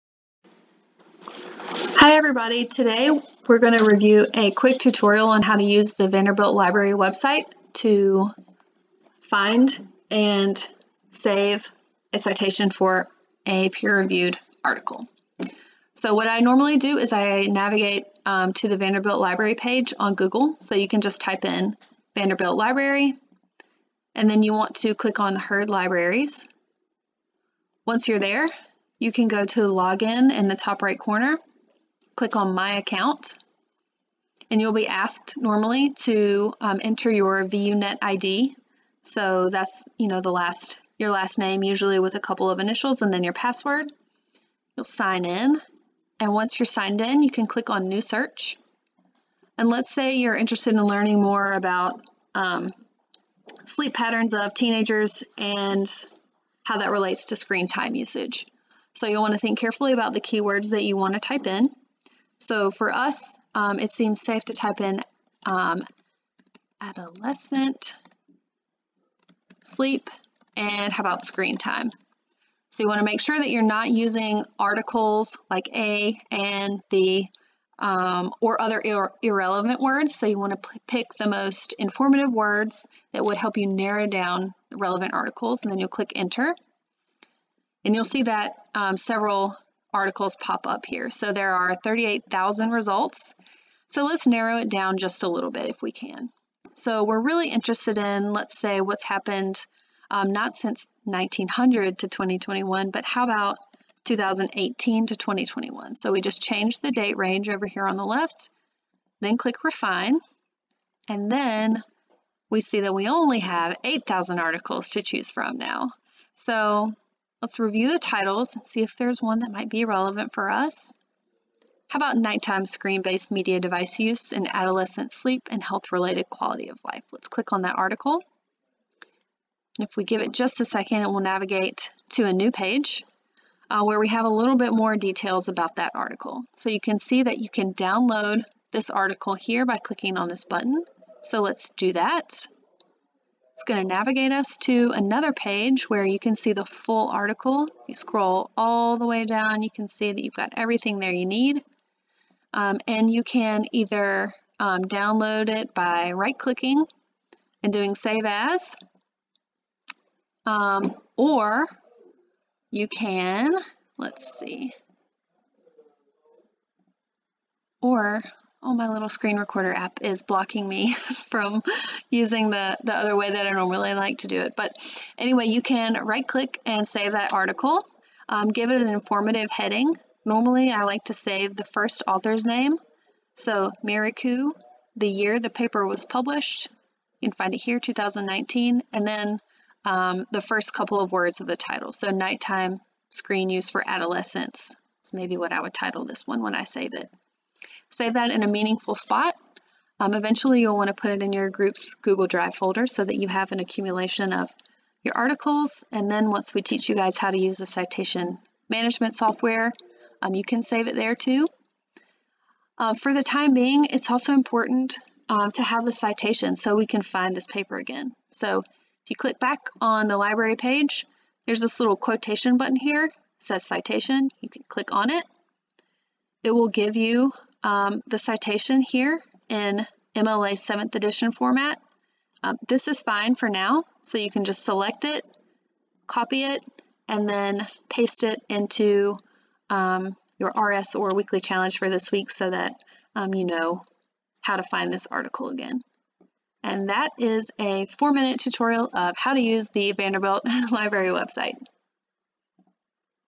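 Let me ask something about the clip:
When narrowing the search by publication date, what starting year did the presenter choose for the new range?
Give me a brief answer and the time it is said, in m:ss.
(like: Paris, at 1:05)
2018, at 1:44.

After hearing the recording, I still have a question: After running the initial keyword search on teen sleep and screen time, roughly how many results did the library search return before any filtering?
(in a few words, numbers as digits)
38,000.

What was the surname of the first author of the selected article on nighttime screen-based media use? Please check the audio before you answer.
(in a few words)
Mireku.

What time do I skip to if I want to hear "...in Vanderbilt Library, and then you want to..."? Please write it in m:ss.
0:21.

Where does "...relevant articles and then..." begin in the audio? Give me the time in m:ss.
1:24.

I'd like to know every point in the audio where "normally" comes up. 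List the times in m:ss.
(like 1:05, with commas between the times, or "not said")
0:16, 0:35, 2:53, 3:00.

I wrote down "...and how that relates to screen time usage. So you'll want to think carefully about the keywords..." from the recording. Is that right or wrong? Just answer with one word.
right.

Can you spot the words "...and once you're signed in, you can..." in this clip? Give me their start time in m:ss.
0:46.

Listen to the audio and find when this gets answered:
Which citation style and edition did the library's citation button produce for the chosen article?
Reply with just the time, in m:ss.
3:50.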